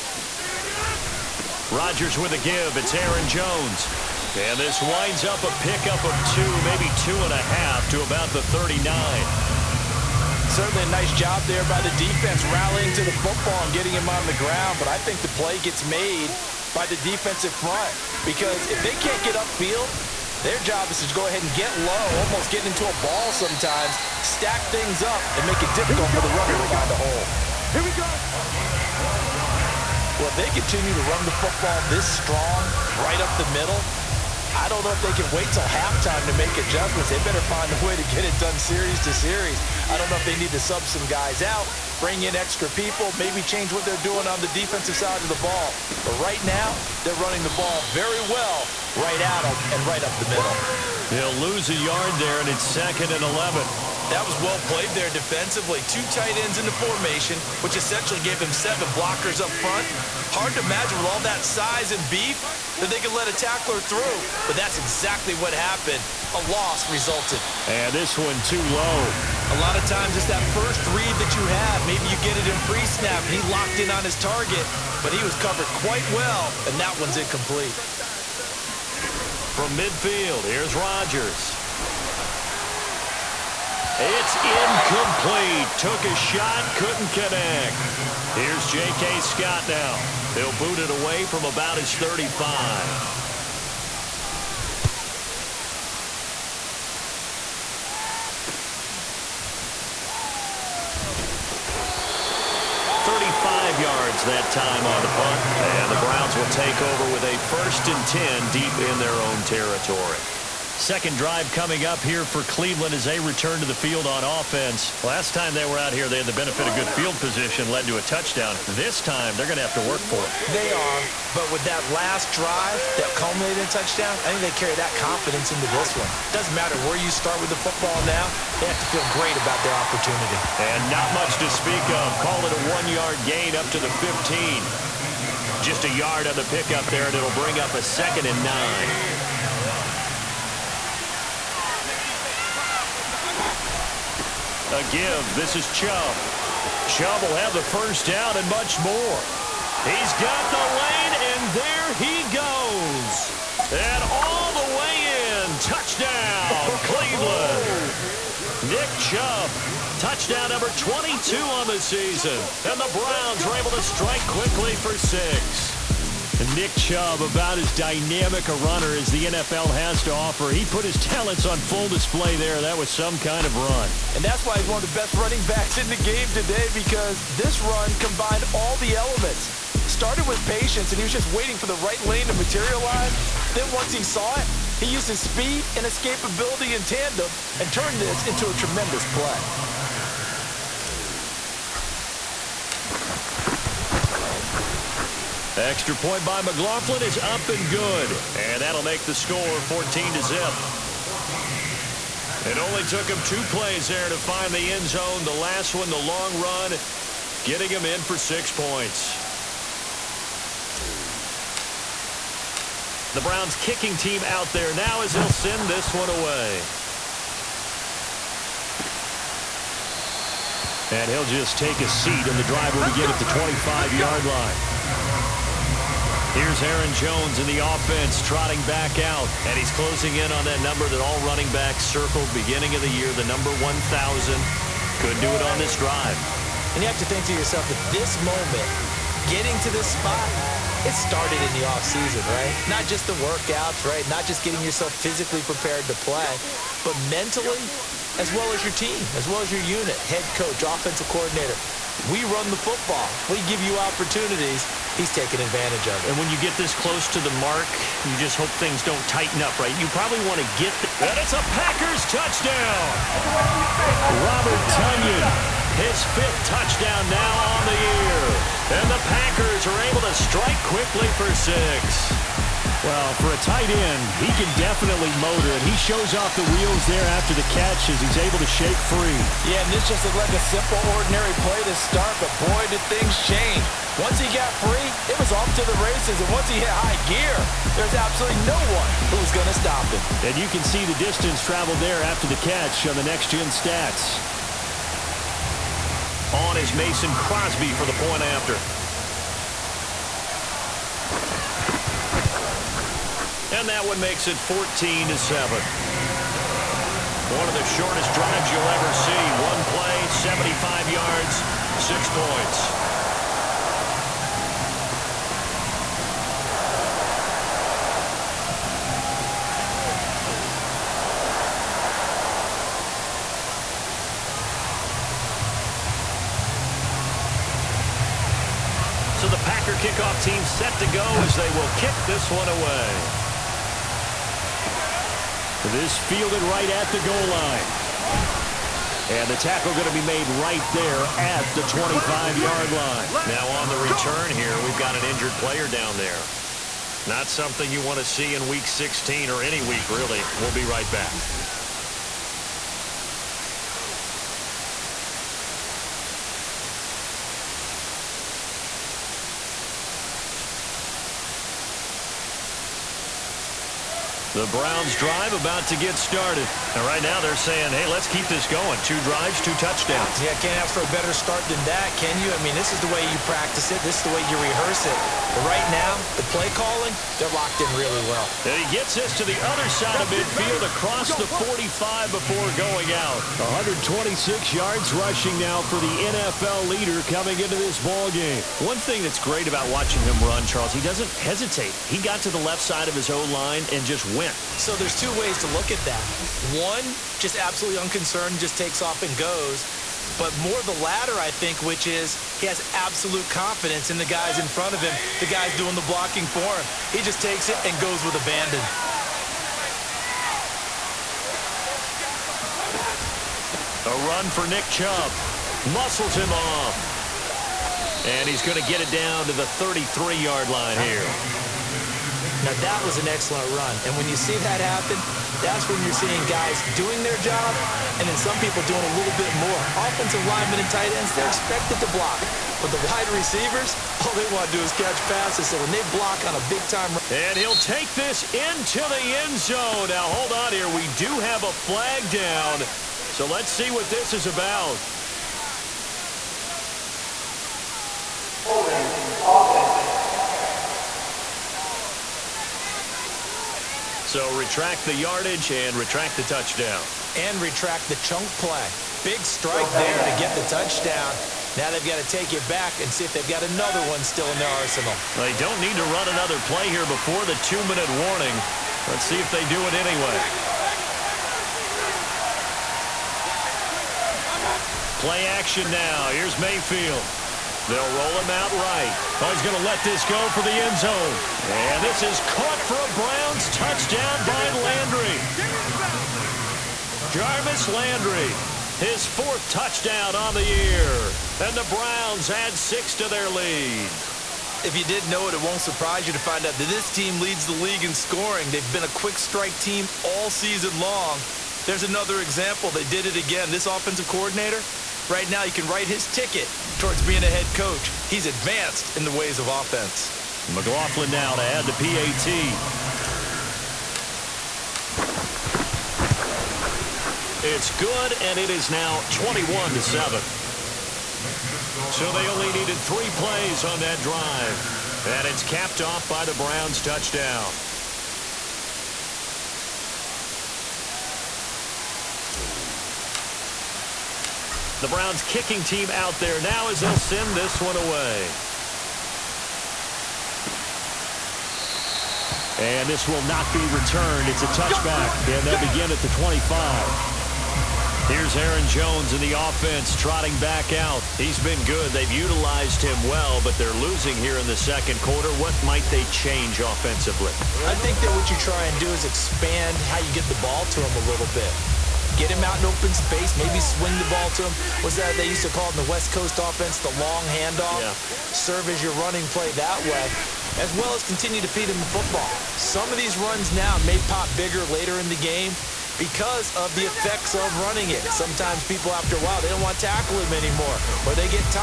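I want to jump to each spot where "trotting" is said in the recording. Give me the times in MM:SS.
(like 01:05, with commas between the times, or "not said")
03:48, 09:09.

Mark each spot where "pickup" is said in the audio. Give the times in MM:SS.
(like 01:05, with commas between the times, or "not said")
00:05, 02:16.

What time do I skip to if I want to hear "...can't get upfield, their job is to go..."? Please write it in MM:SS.
00:19.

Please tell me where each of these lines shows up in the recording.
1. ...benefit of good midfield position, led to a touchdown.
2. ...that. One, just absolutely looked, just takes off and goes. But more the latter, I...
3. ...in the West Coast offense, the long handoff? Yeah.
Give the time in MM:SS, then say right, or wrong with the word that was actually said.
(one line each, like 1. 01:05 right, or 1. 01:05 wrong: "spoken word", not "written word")
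1. 01:56 wrong: "field", not "midfield"
2. 06:35 wrong: "unconcerned", not "looked"
3. 09:25 right.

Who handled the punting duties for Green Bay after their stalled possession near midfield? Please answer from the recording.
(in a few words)
J.K. Scott.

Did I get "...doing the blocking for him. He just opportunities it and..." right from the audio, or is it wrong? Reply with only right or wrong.
wrong.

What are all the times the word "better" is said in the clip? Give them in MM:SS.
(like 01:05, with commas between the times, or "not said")
00:37, 06:10.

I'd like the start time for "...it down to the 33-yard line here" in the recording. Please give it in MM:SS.
06:58.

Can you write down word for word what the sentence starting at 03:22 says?
It only took him two plays there to find the end zone.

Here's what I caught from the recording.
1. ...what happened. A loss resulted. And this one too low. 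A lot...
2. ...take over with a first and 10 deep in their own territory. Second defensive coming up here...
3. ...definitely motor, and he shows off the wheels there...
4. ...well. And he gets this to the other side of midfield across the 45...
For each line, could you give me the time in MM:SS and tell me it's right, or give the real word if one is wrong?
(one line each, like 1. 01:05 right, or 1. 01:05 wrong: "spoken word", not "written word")
1. 01:05 right
2. 01:46 wrong: "drive", not "defensive"
3. 04:34 right
4. 06:18 right.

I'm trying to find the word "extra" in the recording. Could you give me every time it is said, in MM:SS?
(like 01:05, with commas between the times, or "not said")
00:42, 03:15.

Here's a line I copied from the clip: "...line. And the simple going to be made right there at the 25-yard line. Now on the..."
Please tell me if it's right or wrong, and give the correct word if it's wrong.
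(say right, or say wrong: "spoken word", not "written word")
wrong: "tackle", not "simple".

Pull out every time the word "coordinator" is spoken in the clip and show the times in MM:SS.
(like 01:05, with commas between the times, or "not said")
04:11, 08:24.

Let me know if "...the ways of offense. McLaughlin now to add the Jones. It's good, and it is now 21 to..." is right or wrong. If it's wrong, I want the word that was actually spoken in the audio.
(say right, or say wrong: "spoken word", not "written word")
wrong: "PAT", not "Jones".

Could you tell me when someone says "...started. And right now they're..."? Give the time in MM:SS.
06:05.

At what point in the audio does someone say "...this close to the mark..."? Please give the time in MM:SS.
04:16.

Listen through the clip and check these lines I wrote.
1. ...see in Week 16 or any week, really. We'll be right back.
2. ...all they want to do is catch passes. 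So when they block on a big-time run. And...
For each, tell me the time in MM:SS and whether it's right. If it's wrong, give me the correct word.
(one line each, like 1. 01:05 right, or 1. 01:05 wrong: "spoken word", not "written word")
1. 05:48 right
2. 07:14 right.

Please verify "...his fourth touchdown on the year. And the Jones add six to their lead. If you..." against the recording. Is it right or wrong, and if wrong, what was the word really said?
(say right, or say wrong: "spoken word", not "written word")
wrong: "Browns", not "Jones".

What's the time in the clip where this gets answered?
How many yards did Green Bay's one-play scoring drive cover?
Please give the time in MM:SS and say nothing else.
05:10.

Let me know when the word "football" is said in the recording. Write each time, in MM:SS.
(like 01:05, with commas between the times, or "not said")
00:13, 00:31, 02:07, 04:12, 09:31.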